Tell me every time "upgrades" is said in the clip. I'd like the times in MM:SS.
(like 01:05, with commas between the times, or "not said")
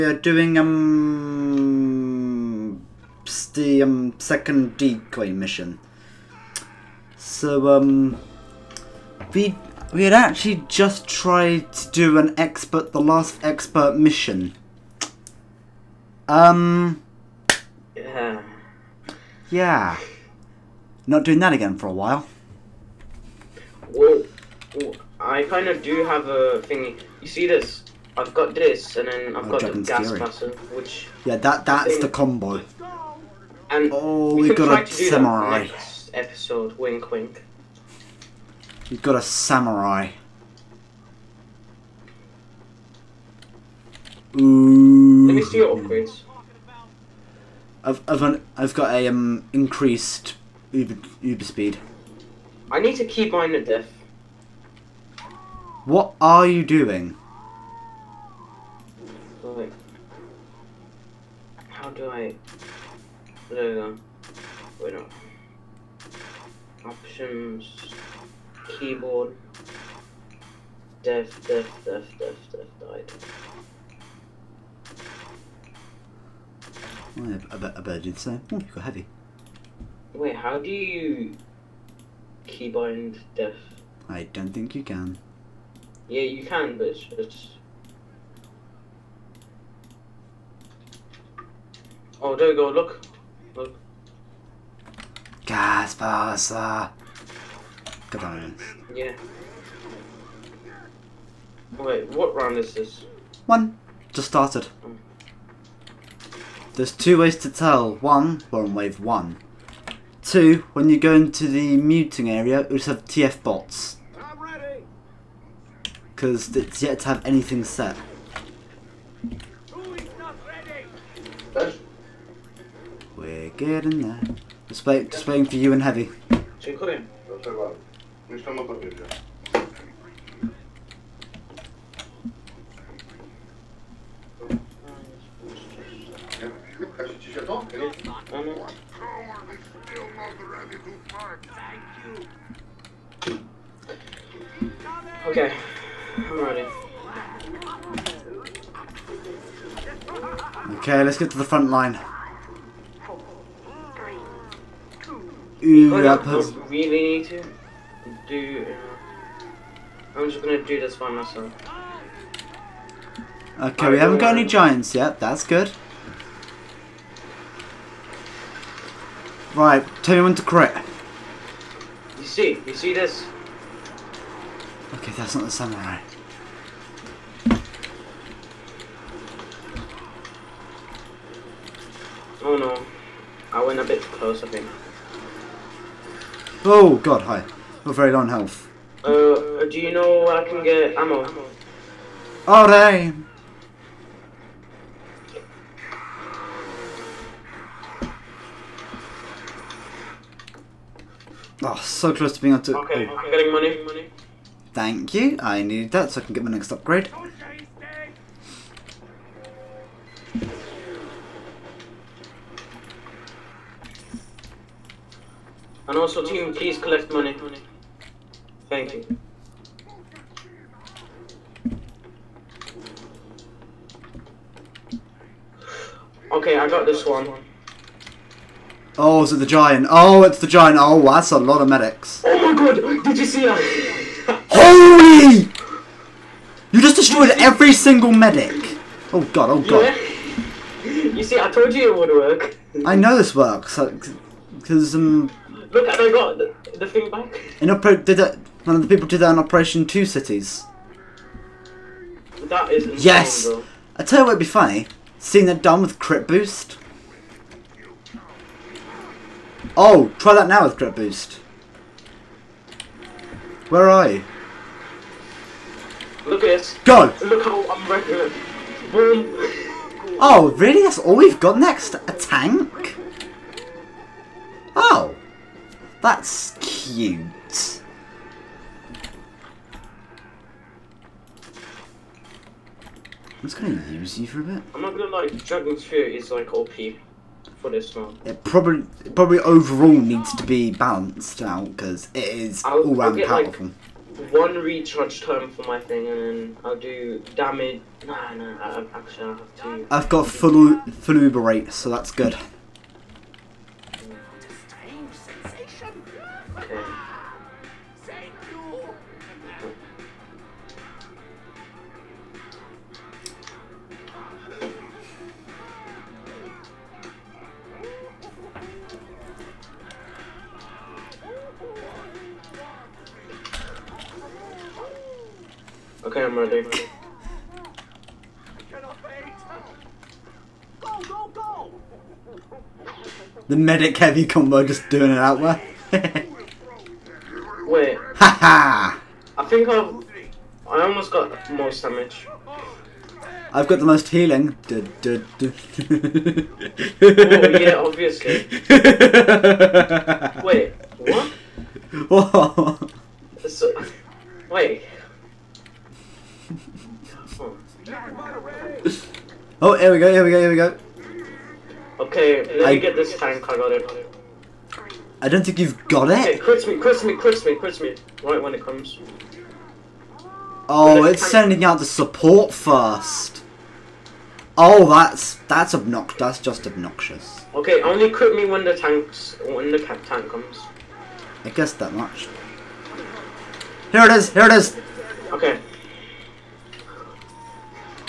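00:45, 03:26.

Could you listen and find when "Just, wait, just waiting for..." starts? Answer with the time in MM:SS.
02:04.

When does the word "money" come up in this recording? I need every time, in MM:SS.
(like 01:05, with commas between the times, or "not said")
03:23, 03:37.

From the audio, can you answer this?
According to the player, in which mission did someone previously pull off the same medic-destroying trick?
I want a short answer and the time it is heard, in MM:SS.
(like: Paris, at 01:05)
Operation Two Cities, at 04:09.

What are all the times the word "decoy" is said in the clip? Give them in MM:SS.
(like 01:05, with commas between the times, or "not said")
00:04.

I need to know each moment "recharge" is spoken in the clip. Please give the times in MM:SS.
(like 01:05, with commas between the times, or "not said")
04:54.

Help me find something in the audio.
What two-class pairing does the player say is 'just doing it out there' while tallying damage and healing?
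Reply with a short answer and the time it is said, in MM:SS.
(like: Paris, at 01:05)
medic heavy combo, at 05:33.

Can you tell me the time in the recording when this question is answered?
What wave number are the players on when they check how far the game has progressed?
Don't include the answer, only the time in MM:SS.
01:48.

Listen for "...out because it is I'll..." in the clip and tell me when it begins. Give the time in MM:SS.
04:51.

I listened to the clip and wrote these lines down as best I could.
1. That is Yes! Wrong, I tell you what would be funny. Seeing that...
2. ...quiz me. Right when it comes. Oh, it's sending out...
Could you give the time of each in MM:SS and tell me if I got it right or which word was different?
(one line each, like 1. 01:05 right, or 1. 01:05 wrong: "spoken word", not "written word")
1. 04:12 right
2. 06:07 right.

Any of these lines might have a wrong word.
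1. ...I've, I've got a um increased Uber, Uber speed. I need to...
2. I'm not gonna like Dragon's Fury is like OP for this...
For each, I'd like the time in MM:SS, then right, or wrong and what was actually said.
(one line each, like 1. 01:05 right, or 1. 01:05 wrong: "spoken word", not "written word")
1. 00:48 right
2. 04:44 right.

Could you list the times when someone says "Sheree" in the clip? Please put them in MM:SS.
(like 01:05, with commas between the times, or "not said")
not said.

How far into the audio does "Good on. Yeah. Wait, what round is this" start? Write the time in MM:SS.
01:38.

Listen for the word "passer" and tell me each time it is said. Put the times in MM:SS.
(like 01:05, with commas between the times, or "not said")
01:35.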